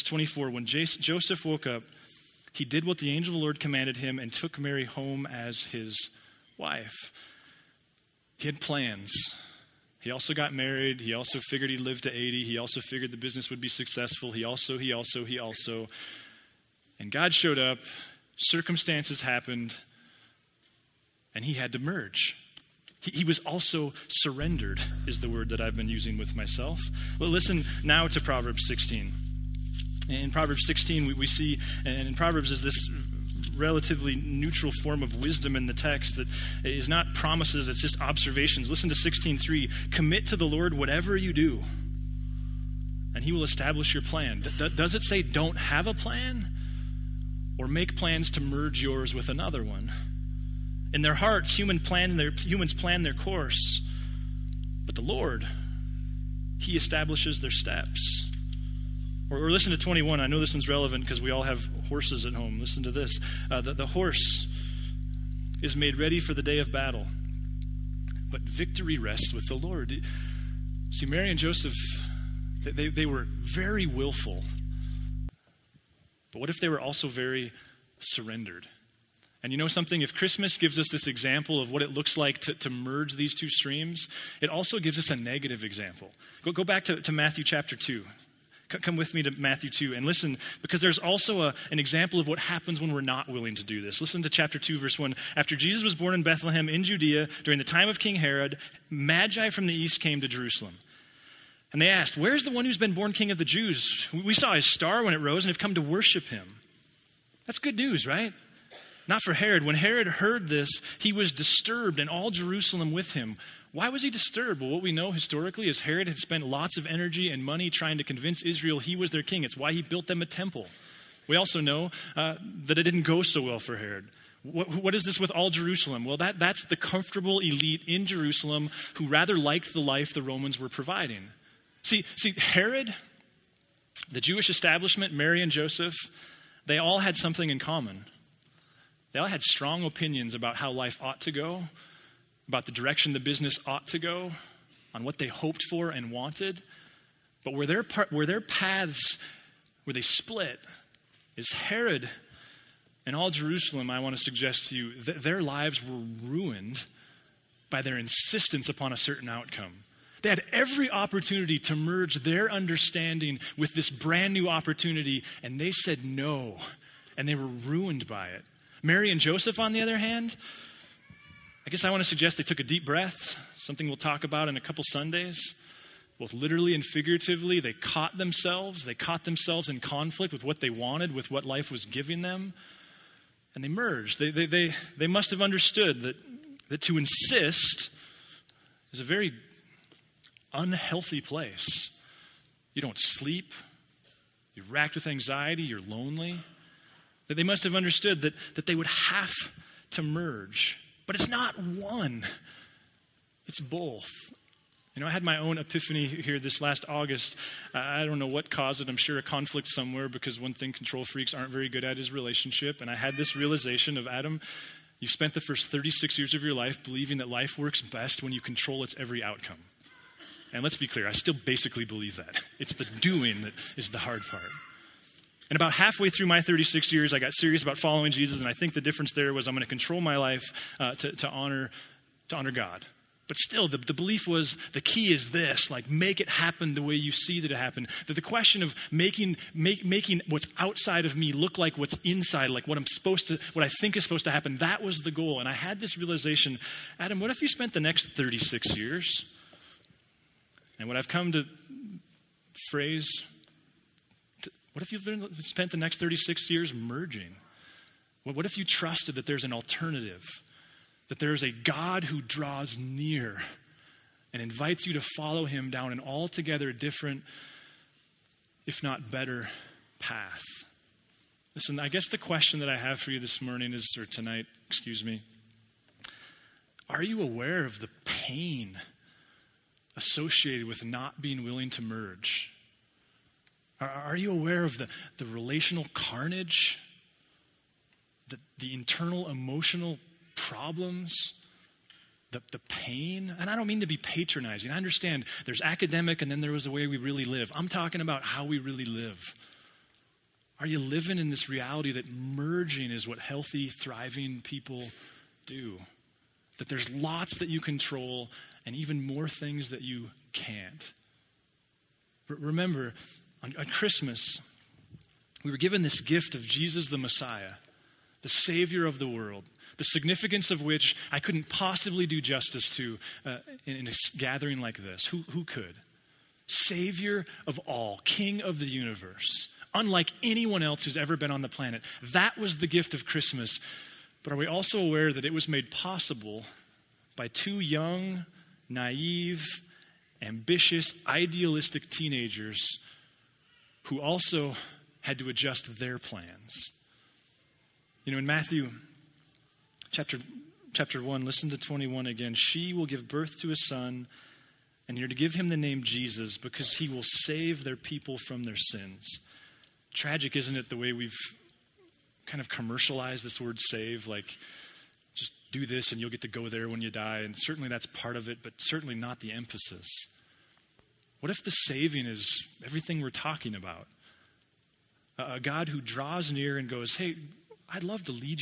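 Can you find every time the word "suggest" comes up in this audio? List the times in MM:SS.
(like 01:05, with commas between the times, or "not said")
02:34, 02:52.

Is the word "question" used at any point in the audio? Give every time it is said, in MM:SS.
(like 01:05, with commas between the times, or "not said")
03:58, 04:32.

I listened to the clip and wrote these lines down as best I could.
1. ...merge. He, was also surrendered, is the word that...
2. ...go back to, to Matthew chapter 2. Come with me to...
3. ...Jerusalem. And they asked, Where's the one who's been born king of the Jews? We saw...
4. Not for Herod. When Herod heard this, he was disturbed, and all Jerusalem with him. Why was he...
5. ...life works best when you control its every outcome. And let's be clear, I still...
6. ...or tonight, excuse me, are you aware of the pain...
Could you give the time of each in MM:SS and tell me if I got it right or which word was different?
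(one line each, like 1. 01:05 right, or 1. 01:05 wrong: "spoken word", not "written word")
1. 00:21 right
2. 01:26 right
3. 01:40 right
4. 01:49 right
5. 03:37 right
6. 04:33 right.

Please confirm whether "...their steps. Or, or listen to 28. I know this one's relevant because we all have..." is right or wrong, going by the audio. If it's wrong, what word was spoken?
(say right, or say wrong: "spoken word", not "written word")
wrong: "21", not "28".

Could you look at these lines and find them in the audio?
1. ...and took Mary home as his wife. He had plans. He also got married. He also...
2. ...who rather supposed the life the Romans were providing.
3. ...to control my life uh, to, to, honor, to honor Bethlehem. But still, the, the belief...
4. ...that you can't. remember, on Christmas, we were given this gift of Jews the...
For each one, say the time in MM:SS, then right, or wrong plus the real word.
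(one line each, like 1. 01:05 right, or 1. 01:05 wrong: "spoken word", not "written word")
1. 00:04 right
2. 02:08 wrong: "liked", not "supposed"
3. 03:49 wrong: "God", not "Bethlehem"
4. 05:09 wrong: "Jesus", not "Jews".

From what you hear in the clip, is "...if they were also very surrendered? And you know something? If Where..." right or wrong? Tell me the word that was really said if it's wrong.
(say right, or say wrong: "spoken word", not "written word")
wrong: "Christmas", not "Where".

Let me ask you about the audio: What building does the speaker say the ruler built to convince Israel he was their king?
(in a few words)
a temple.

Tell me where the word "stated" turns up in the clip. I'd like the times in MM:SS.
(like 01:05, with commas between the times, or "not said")
not said.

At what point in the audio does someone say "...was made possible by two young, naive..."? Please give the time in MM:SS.
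05:35.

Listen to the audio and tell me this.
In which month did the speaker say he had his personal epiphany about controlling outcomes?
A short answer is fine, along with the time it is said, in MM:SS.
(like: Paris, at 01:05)
August, at 03:26.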